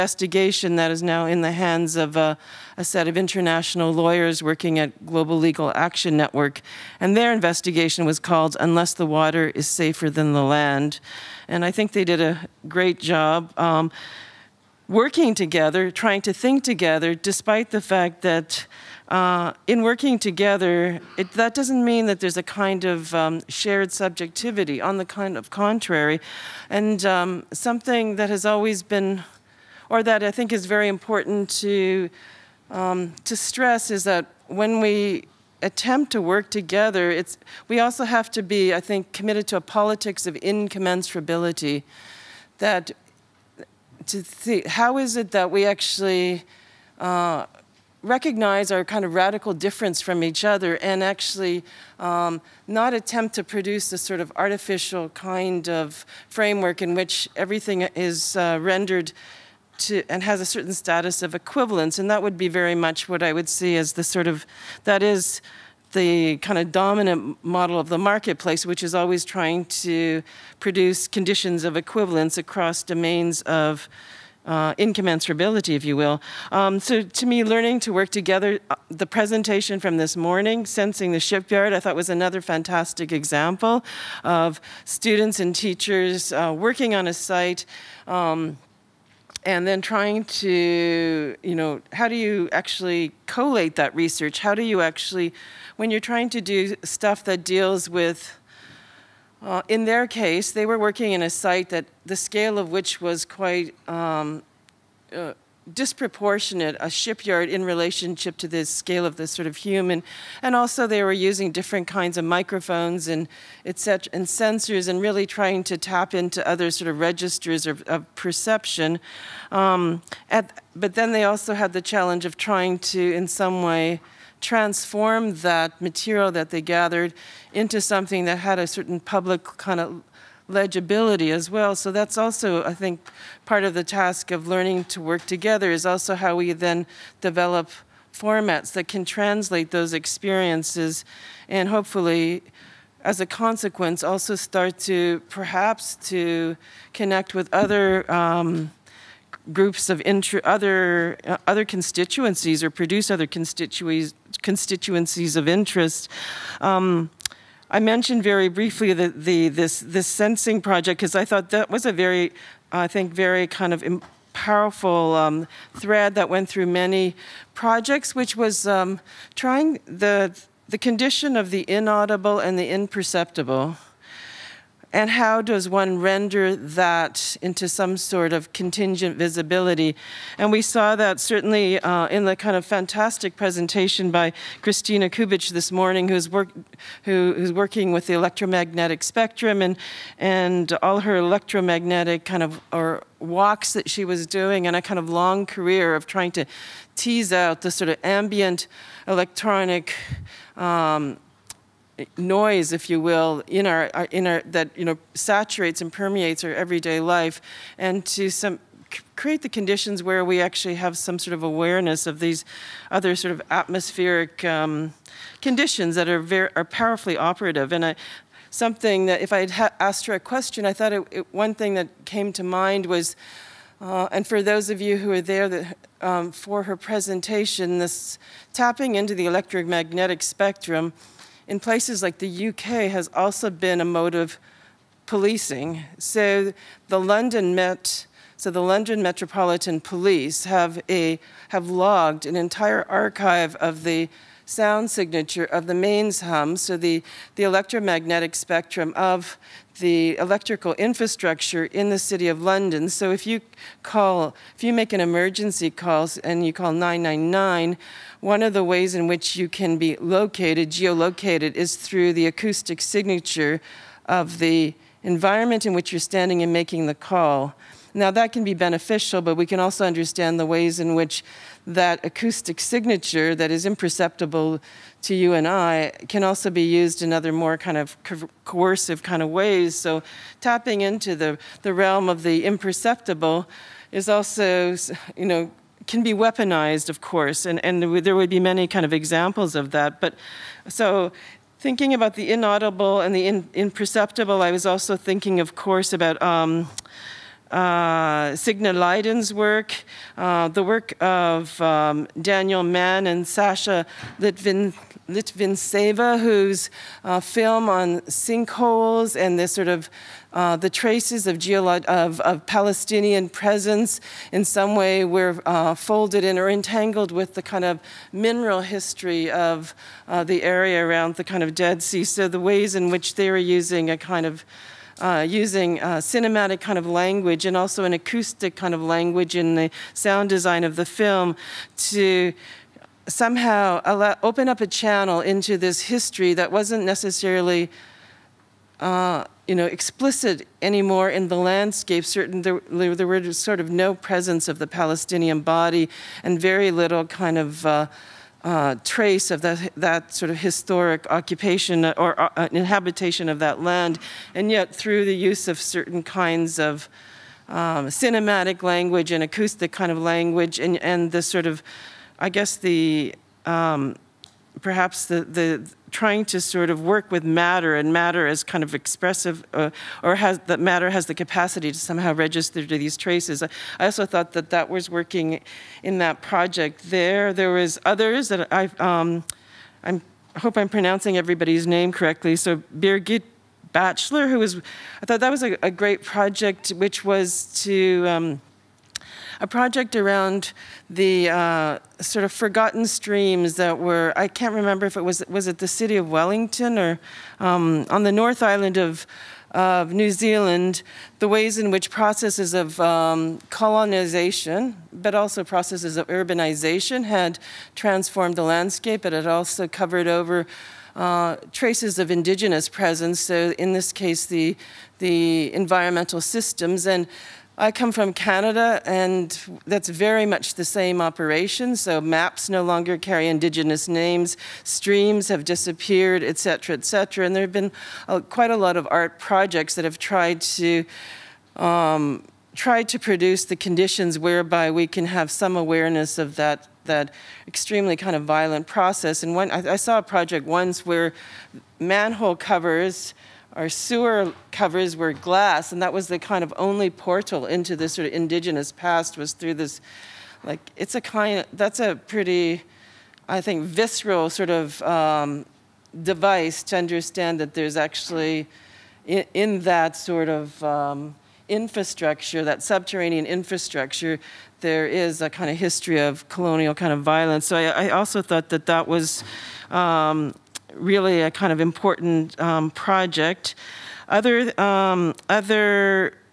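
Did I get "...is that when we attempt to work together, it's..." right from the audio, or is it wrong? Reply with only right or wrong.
right.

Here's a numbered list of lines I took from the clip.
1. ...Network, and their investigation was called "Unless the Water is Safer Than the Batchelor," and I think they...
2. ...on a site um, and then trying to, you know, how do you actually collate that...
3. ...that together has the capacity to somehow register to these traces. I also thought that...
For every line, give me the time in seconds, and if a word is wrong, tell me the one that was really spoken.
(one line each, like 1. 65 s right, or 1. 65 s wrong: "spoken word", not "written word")
1. 6 s wrong: "Land", not "Batchelor"
2. 86 s right
3. 370 s wrong: "matter", not "together".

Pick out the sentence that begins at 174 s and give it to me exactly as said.
And how does one render that into some sort of contingent visibility?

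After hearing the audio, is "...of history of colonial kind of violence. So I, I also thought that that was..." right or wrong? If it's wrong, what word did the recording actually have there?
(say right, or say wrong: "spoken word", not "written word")
right.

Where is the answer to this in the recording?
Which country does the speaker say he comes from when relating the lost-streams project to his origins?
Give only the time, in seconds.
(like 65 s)
418 s.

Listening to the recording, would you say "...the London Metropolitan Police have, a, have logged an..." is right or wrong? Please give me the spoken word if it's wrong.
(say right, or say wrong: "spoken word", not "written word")
right.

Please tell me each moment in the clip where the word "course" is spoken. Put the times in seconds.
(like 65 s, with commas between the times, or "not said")
286 s, 295 s.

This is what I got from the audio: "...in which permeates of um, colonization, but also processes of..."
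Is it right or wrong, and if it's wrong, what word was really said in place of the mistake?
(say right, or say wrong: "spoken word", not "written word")
wrong: "processes", not "permeates".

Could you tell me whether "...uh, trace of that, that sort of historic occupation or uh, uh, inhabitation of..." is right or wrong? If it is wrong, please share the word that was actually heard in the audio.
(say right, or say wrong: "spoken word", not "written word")
right.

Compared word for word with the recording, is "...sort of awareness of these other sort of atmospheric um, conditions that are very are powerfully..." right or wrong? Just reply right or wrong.
right.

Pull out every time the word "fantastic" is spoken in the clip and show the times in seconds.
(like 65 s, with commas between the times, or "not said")
82 s, 182 s.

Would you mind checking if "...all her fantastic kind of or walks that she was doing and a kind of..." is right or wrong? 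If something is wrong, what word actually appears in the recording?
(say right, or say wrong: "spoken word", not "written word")
wrong: "electromagnetic", not "fantastic".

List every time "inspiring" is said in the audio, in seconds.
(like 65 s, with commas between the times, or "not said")
not said.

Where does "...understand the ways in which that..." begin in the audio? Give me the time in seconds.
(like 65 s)
269 s.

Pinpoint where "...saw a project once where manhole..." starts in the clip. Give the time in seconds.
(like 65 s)
439 s.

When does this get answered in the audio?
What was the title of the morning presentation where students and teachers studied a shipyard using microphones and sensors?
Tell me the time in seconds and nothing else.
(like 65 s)
80 s.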